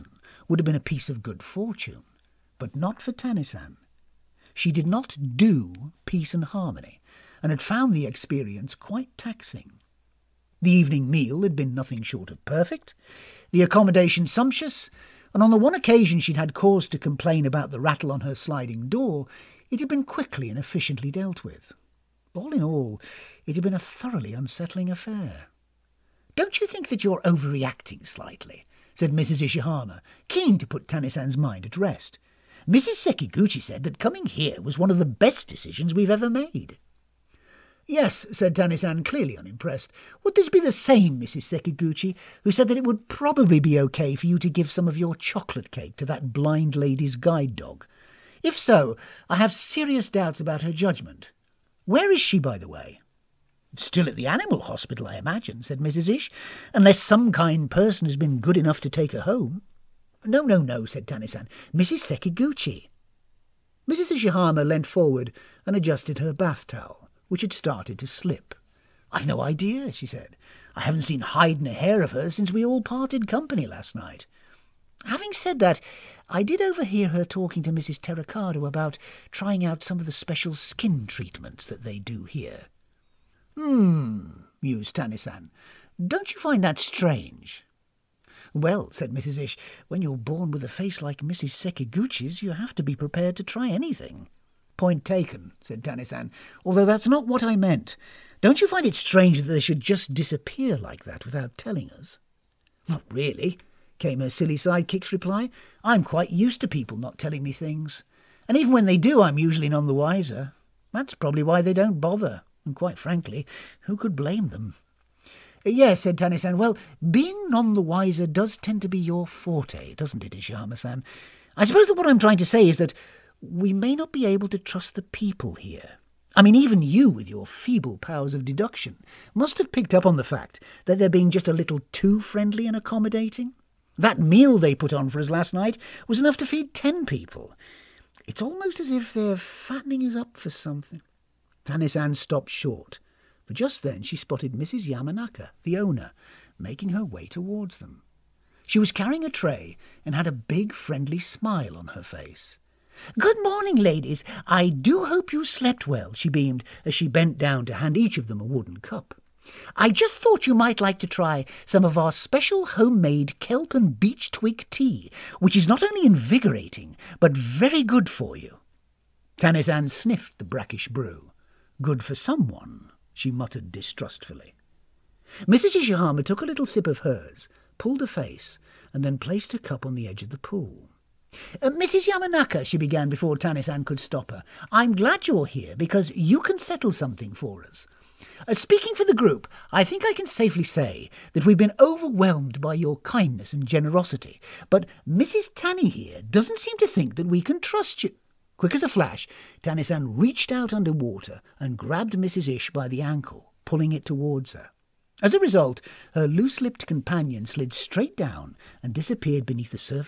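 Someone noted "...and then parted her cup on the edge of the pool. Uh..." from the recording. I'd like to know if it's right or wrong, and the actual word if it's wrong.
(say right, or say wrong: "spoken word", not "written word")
wrong: "placed", not "parted".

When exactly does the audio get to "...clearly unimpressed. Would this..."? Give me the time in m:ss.
0:39.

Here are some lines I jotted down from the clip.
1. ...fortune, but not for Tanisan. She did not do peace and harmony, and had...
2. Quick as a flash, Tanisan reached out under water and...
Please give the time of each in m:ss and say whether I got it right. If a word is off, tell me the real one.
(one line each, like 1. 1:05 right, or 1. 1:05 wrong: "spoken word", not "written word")
1. 0:01 right
2. 3:18 right.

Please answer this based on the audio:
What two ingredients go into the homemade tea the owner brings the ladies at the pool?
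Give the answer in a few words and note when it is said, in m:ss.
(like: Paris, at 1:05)
Kelp and beech twig, at 2:43.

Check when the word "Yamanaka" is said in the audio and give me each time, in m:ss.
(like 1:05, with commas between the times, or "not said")
2:24, 3:02.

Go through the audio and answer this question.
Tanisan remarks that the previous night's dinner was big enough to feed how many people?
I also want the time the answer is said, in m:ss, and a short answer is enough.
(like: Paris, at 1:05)
10, at 2:16.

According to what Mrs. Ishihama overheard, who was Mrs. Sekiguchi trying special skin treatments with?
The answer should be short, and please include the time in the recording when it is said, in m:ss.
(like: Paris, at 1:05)
Mrs. Terakado, at 1:17.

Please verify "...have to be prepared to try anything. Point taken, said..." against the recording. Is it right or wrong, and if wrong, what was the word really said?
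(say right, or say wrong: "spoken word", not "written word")
right.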